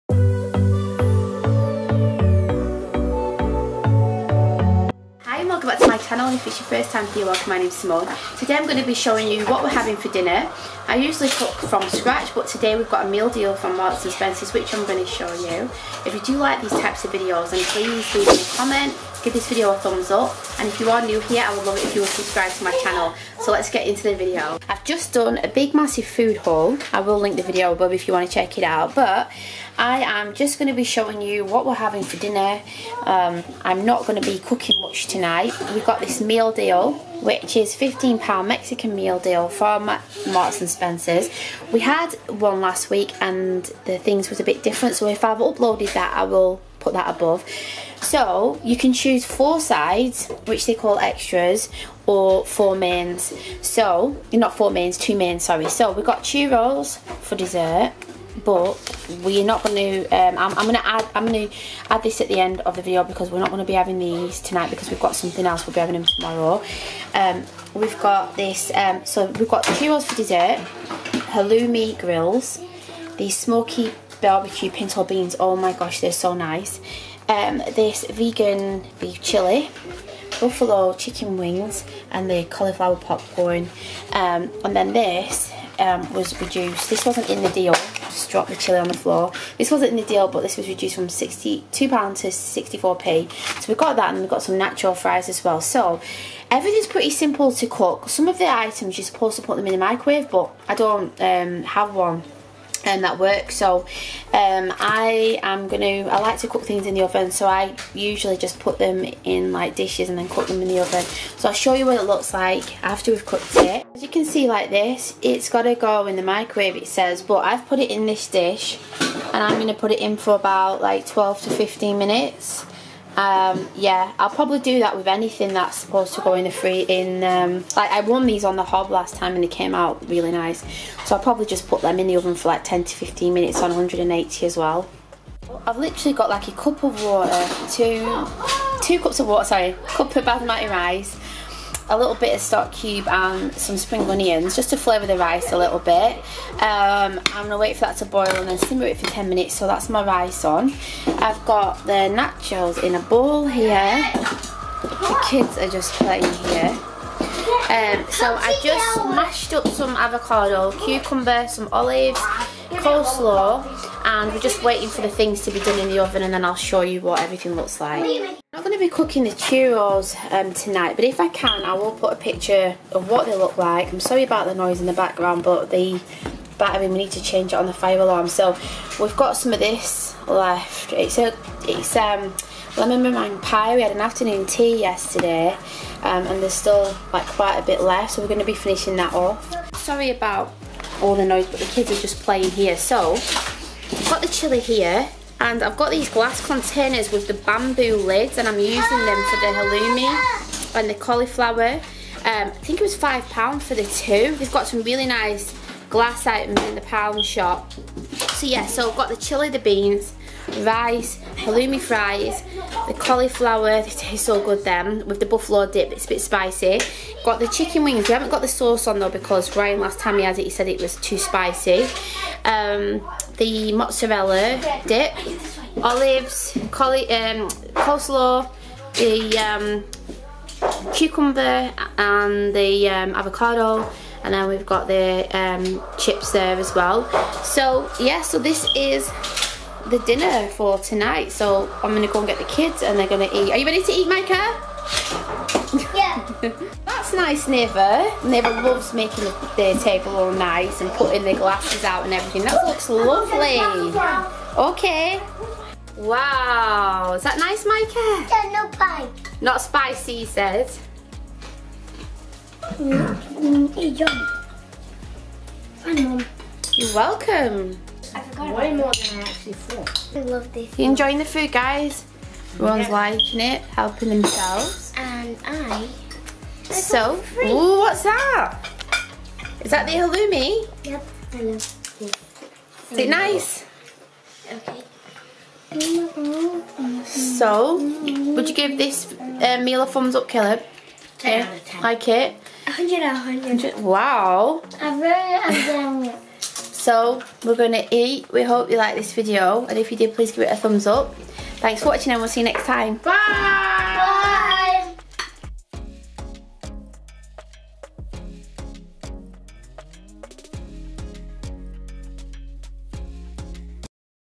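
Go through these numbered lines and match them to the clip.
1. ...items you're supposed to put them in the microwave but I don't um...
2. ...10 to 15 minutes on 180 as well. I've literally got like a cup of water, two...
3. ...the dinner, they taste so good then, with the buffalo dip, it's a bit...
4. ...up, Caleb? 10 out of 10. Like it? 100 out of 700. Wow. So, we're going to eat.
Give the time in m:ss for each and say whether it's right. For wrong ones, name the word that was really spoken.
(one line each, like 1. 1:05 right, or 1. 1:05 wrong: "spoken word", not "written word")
1. 1:38 right
2. 2:12 right
3. 3:32 wrong: "cauliflower", not "dinner"
4. 4:50 wrong: "100", not "700".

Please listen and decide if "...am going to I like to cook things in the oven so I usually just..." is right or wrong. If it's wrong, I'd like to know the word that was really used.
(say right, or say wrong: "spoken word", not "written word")
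right.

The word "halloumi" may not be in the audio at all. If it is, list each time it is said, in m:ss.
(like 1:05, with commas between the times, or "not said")
1:11, 3:19, 3:31, 4:39.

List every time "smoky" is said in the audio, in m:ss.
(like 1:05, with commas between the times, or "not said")
1:13.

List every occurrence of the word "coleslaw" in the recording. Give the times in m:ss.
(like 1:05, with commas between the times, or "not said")
2:42, 3:47.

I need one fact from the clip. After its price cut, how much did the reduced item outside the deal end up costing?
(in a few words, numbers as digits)
64p.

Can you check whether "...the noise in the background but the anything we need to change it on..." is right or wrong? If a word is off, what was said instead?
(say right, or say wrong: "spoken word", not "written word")
wrong: "battering", not "anything".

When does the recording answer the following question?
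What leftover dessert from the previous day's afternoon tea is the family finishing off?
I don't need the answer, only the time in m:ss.
3:02.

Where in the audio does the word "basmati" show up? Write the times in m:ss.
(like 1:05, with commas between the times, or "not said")
2:20.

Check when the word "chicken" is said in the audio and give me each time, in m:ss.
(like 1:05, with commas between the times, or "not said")
1:20, 3:37.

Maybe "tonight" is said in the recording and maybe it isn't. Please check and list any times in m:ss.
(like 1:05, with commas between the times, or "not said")
0:35, 1:04, 2:50, 4:00.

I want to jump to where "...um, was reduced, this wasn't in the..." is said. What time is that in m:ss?
1:25.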